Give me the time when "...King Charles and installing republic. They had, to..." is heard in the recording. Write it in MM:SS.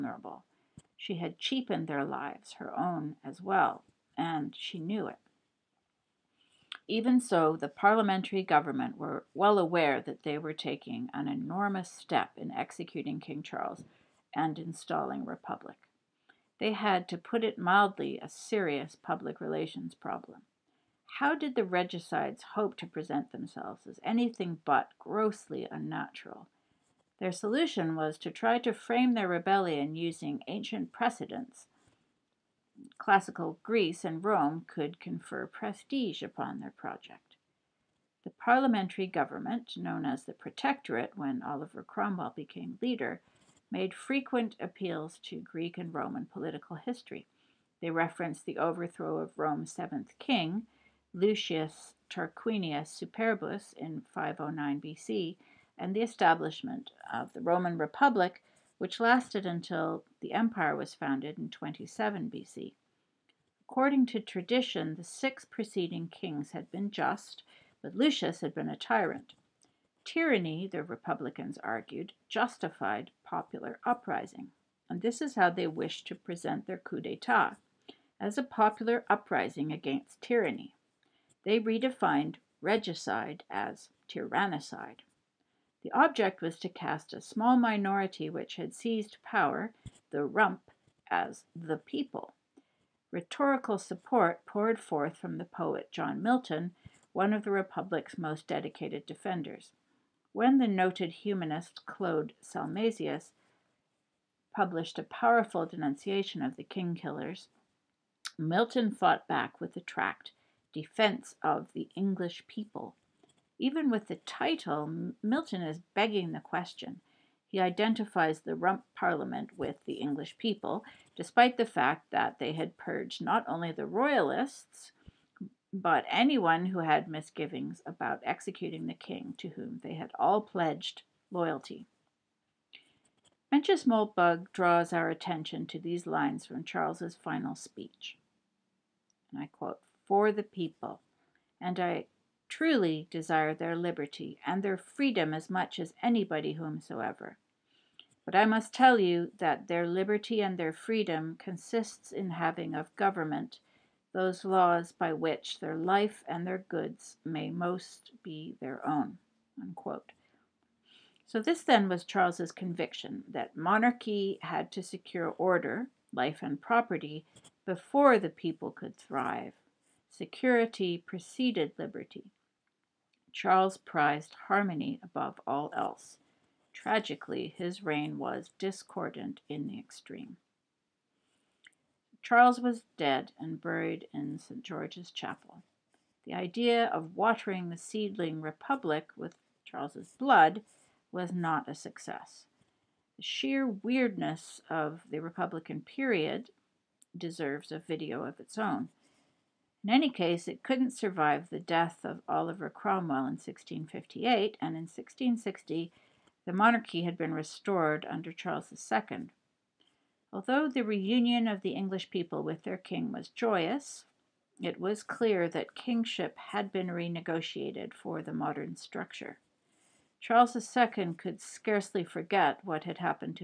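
00:13.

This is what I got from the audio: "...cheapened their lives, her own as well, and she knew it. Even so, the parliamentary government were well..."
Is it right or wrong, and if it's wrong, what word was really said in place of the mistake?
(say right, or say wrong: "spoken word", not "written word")
right.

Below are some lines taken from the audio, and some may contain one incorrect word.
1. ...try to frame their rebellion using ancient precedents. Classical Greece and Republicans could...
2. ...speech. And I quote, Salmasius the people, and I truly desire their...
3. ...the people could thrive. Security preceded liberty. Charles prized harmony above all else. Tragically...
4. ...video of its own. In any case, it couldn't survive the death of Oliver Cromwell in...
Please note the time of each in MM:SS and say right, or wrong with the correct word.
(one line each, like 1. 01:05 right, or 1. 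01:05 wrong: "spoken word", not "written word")
1. 00:28 wrong: "Rome", not "Republicans"
2. 02:17 wrong: "For", not "Salmasius"
3. 02:48 right
4. 03:17 right.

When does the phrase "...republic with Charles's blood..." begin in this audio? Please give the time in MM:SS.
03:08.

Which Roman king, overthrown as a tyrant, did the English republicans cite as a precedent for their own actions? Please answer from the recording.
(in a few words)
Lucius Tarquinius Superbus.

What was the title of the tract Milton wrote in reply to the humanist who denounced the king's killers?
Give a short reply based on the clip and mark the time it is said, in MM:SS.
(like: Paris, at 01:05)
Defense of the English People, at 01:50.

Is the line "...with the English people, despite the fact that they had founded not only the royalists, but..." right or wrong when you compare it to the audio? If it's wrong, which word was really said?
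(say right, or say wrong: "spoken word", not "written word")
wrong: "purged", not "founded".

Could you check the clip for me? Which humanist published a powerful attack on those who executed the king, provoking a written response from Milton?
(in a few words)
Claude Salmasius.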